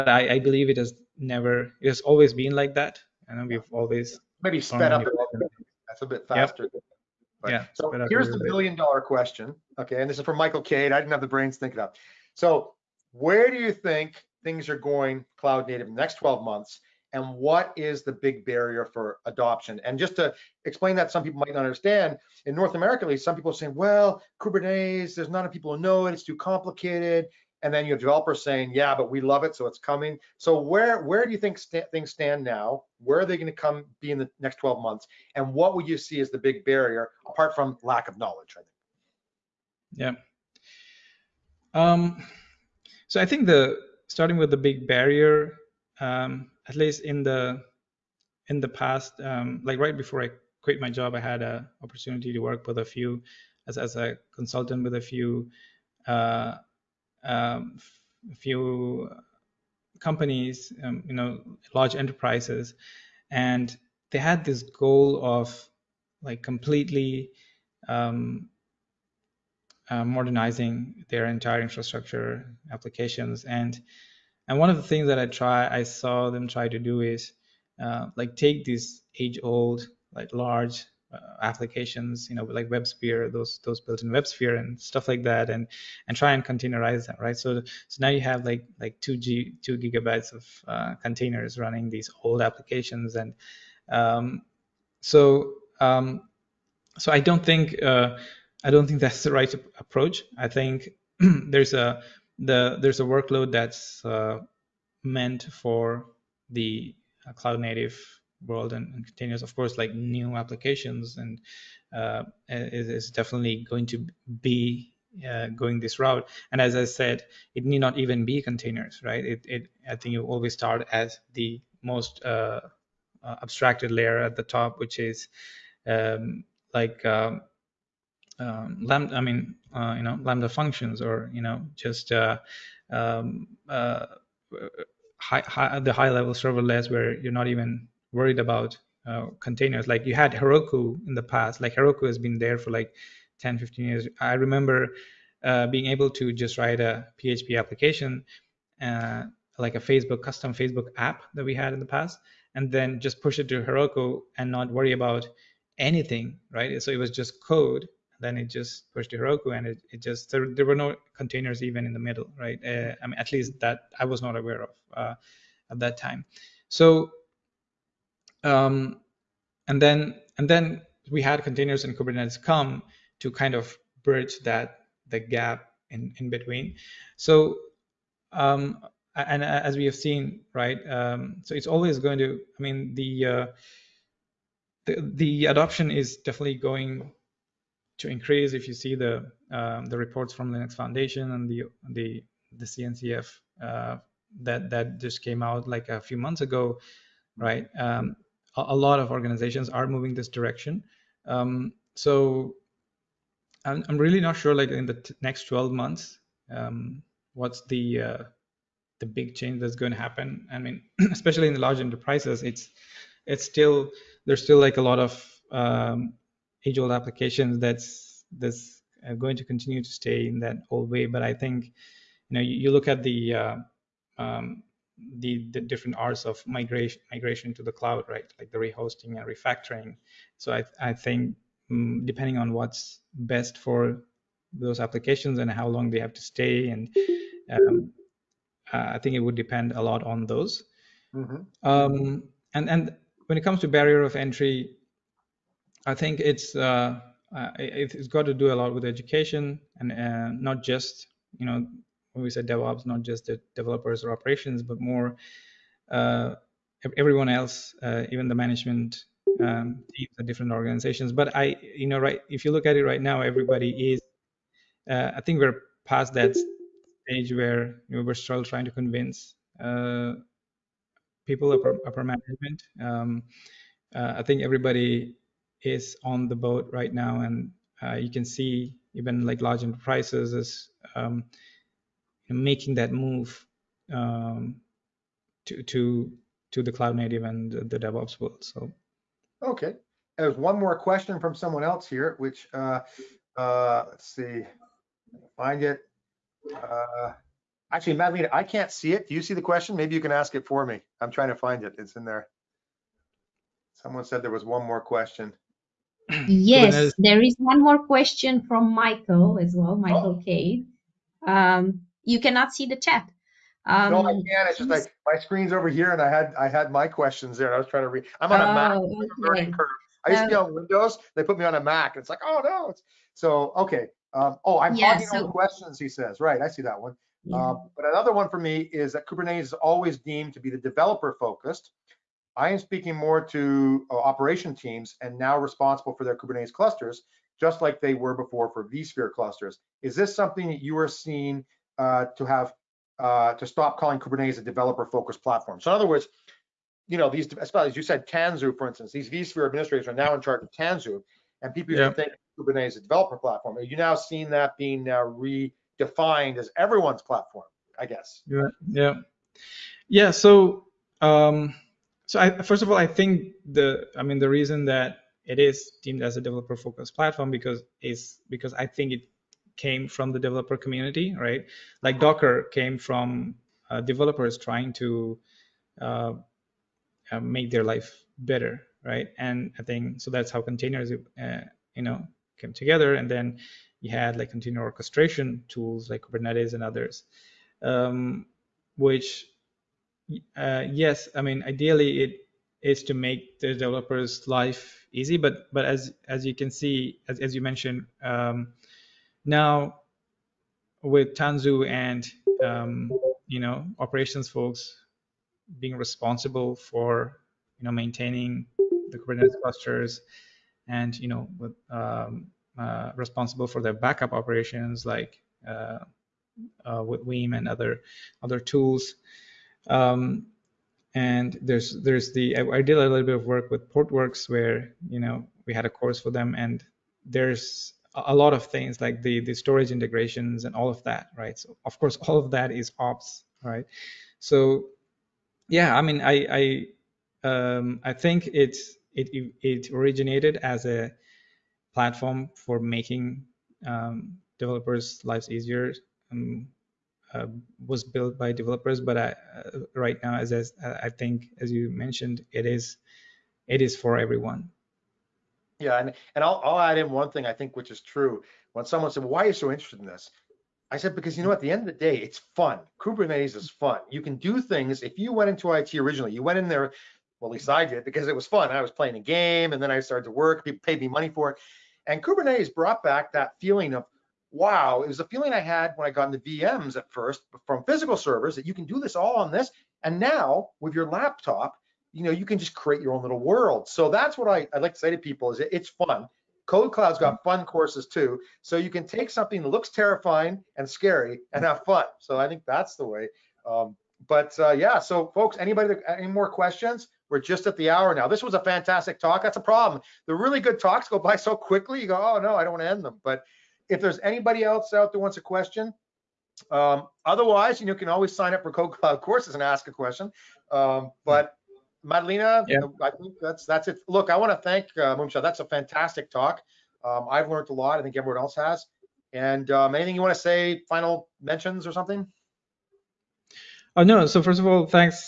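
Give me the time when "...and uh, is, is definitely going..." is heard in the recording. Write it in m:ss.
1:51.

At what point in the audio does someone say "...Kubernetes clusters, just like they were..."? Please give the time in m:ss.
5:36.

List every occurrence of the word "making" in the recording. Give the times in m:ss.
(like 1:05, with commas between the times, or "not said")
4:42, 7:22.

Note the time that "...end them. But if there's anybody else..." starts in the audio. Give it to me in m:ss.
8:22.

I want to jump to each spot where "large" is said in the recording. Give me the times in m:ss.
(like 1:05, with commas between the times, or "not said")
1:01, 1:20, 3:31, 4:39.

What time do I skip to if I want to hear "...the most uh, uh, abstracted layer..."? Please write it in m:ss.
2:01.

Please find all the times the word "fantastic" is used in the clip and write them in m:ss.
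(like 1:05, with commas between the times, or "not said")
8:18, 8:35.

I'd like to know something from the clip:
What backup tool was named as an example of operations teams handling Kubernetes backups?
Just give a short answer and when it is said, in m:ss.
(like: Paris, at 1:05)
Veeam, at 6:57.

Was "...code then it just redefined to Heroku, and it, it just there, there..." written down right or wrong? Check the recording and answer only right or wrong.
wrong.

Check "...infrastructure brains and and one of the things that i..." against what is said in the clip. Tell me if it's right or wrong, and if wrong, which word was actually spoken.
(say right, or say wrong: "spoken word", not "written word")
wrong: "applications", not "brains".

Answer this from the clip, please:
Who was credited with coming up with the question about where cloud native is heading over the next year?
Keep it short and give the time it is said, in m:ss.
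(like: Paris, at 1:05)
Michael Cade, at 0:10.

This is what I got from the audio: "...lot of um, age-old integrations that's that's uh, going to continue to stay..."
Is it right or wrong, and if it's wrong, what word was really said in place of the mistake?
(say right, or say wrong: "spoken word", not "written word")
wrong: "applications", not "integrations".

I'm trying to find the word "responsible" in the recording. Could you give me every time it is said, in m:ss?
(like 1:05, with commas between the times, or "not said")
5:35, 6:45, 6:52.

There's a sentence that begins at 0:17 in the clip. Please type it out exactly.
and what is the big barrier for adoption?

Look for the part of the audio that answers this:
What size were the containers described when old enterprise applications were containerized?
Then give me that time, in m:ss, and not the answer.
1:29.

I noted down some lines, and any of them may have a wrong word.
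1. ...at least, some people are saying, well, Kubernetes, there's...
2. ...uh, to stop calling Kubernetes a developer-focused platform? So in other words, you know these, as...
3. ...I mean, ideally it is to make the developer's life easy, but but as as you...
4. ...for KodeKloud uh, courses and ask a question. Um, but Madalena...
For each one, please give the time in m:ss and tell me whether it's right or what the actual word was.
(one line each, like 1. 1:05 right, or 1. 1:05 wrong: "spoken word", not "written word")
1. 0:23 right
2. 5:42 right
3. 6:31 right
4. 8:28 right.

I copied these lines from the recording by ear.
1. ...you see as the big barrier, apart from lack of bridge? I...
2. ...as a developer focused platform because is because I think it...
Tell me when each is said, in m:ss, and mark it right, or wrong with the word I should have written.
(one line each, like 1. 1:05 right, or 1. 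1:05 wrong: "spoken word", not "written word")
1. 0:35 wrong: "knowledge", not "bridge"
2. 6:06 right.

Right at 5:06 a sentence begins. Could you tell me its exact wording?
Yes, there is one more question from Michael as well, Michael oh.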